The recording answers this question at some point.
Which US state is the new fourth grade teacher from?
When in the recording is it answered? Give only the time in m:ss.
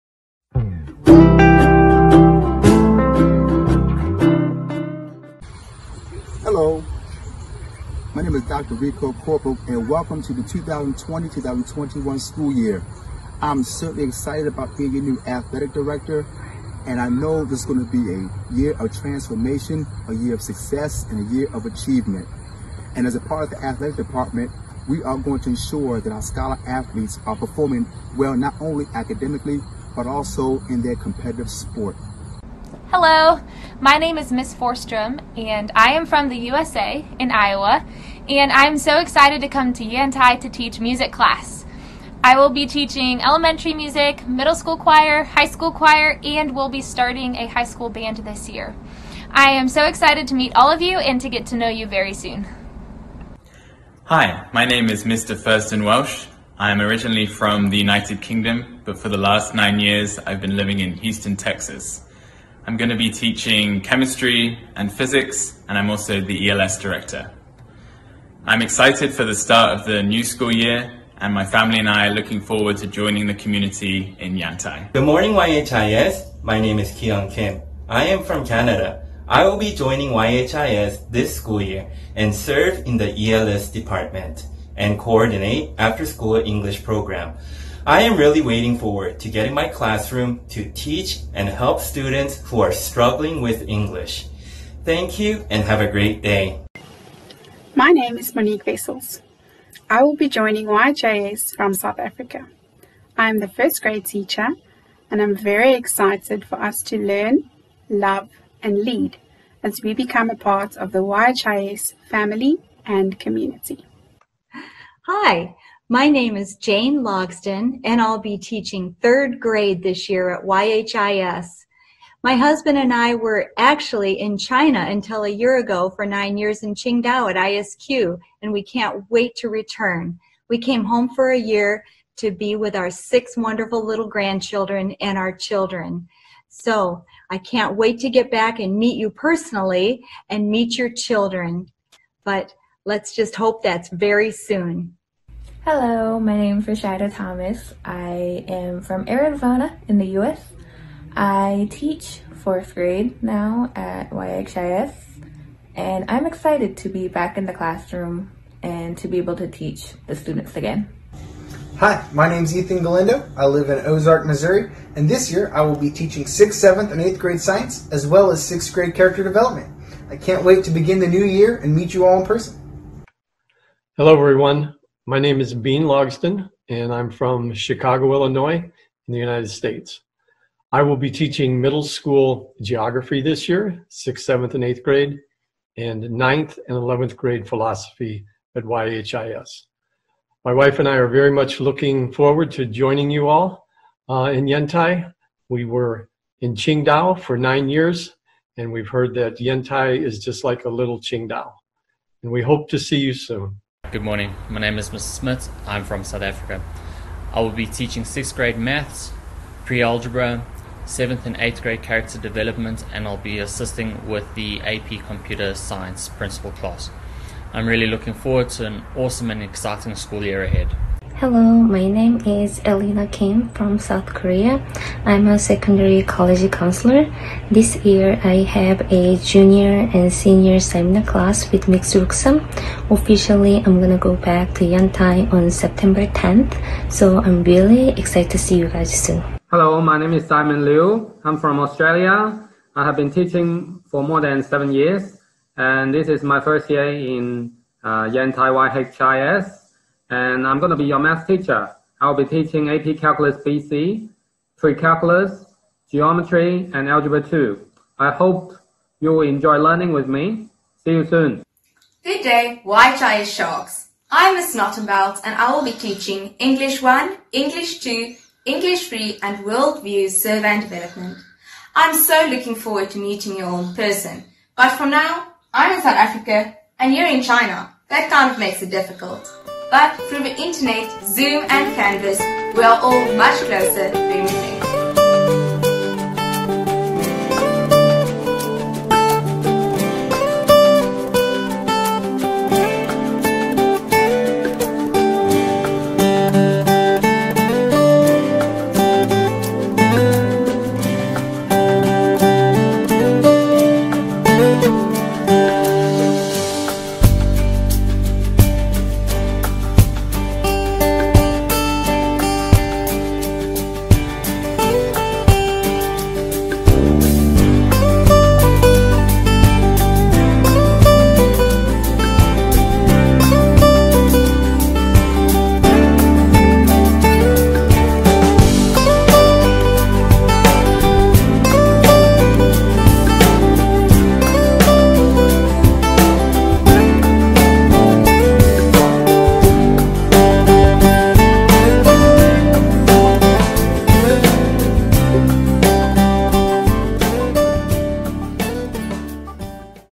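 2:29.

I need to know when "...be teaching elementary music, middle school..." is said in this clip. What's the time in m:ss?
0:42.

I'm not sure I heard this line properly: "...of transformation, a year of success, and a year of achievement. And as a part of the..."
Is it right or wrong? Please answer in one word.
right.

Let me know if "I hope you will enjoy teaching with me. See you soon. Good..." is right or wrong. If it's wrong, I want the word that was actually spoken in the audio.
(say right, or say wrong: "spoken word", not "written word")
wrong: "learning", not "teaching".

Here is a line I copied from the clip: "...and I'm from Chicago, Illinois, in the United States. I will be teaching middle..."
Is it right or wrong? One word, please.
right.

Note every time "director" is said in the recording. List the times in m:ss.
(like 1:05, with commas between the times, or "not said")
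0:15, 1:06.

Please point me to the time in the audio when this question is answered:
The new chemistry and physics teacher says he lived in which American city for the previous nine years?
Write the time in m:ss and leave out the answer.
1:00.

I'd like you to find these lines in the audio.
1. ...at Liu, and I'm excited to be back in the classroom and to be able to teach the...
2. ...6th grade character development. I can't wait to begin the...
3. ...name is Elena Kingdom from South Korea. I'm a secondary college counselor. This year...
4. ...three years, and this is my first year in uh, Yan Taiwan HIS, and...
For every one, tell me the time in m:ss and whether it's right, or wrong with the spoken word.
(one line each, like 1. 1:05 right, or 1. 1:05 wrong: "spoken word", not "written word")
1. 2:33 wrong: "YHIS", not "Liu"
2. 2:48 right
3. 3:41 wrong: "Kim", not "Kingdom"
4. 4:04 wrong: "seven", not "three".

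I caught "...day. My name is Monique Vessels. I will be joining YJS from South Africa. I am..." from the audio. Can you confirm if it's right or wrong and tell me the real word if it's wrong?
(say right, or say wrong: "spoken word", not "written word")
right.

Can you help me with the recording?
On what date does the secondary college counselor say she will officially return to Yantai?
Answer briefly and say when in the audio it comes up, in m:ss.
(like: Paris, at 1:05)
September 10, at 3:55.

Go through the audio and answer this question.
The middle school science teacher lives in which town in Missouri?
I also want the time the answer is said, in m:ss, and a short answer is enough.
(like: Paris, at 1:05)
Ozark, at 2:43.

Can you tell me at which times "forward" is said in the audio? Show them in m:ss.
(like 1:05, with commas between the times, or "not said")
1:12, 1:28, 3:12, 3:38, 4:32.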